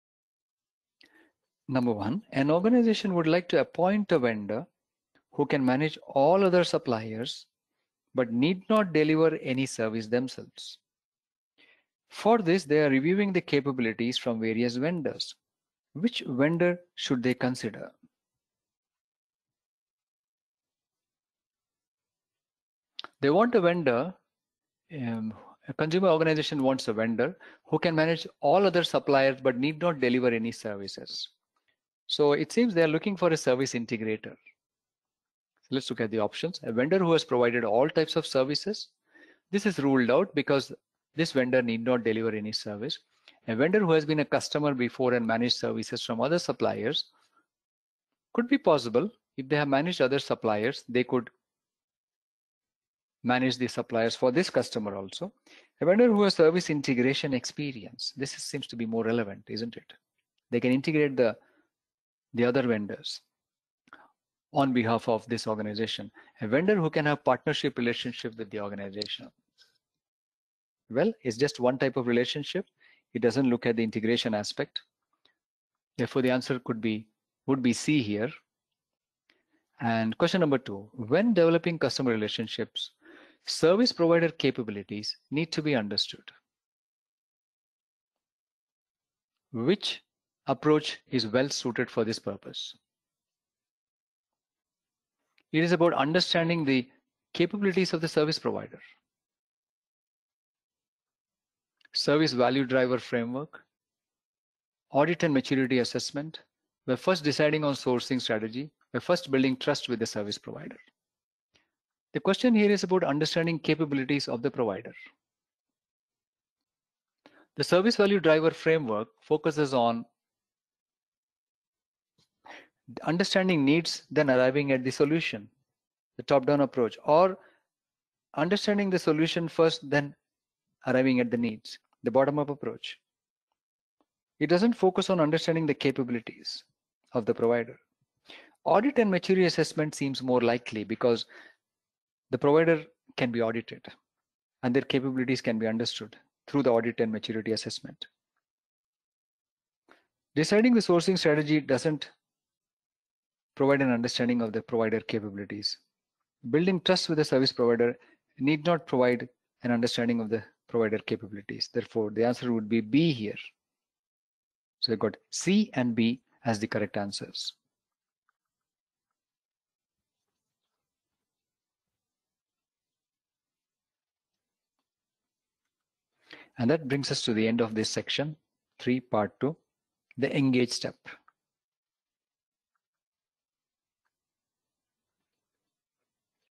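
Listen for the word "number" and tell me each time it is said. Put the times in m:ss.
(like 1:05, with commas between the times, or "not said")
0:01, 1:20.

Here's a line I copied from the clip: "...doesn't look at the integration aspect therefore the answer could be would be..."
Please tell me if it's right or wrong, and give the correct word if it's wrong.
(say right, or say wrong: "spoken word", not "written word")
right.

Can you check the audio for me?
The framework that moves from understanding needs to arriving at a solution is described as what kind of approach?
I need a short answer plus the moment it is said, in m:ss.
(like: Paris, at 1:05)
Top down approach, at 2:06.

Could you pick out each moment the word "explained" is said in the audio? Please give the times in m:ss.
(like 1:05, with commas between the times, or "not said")
not said.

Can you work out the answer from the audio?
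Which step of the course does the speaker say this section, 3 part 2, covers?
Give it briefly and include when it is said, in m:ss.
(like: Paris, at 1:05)
The engage step, at 3:00.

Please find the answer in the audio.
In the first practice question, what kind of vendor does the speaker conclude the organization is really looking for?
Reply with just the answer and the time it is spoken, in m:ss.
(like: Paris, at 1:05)
Service integrator, at 0:33.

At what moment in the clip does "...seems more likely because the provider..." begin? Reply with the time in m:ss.
2:19.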